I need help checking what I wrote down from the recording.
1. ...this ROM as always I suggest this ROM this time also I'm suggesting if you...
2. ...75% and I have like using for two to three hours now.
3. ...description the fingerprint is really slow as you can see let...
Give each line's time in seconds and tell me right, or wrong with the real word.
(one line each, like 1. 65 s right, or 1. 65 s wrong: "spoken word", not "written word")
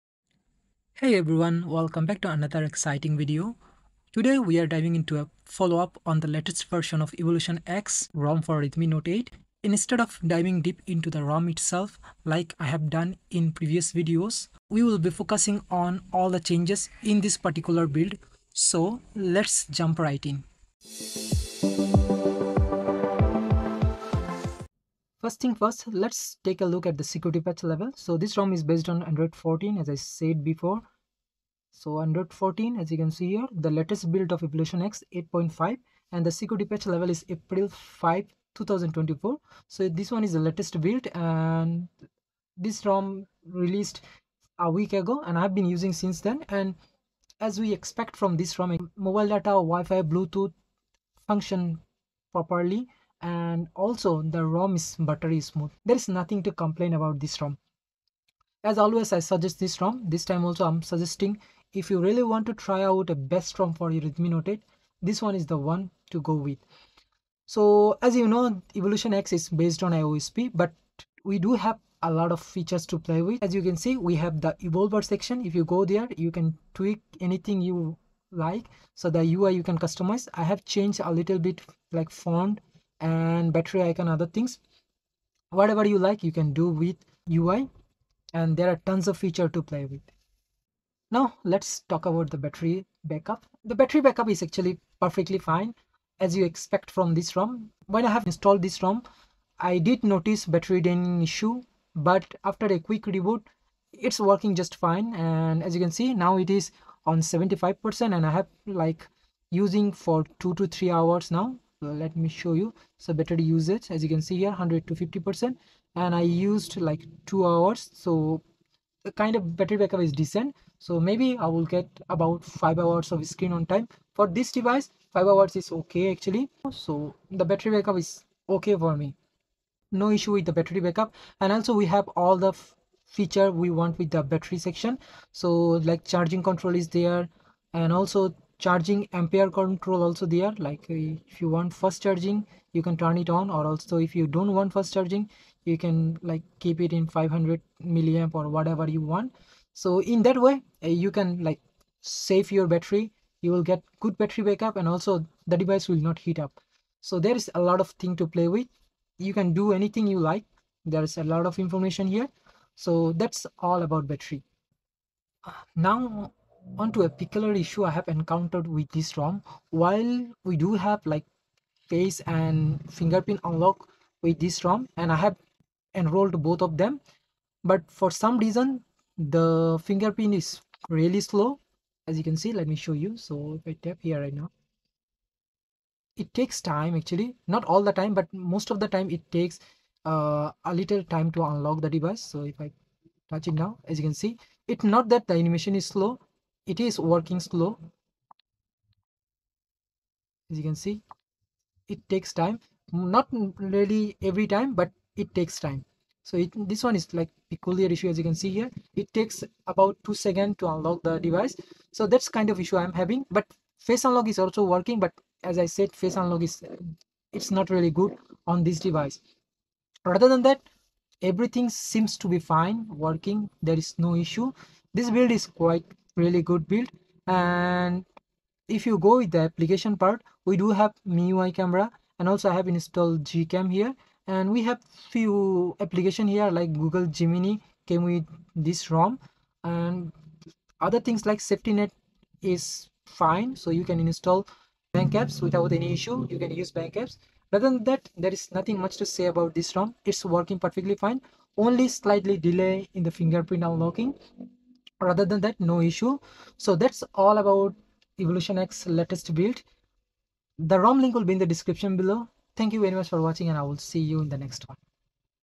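1. 57 s right
2. 107 s right
3. 178 s wrong: "reason", not "description".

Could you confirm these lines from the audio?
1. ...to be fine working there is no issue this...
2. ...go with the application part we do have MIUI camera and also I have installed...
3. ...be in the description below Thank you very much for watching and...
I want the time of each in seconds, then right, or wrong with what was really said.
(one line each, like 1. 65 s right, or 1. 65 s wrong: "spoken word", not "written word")
1. 222 s right
2. 229 s right
3. 261 s right.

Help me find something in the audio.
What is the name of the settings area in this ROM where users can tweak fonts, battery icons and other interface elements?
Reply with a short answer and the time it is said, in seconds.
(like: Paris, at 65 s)
evolver, at 74 s.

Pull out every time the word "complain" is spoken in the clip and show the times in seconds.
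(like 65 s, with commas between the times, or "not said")
56 s.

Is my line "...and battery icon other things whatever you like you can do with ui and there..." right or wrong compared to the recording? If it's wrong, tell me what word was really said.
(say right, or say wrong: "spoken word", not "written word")
right.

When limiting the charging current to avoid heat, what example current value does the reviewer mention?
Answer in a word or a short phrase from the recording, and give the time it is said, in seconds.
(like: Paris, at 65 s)
500 milliamp, at 147 s.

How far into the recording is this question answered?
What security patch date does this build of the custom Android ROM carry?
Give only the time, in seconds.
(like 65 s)
37 s.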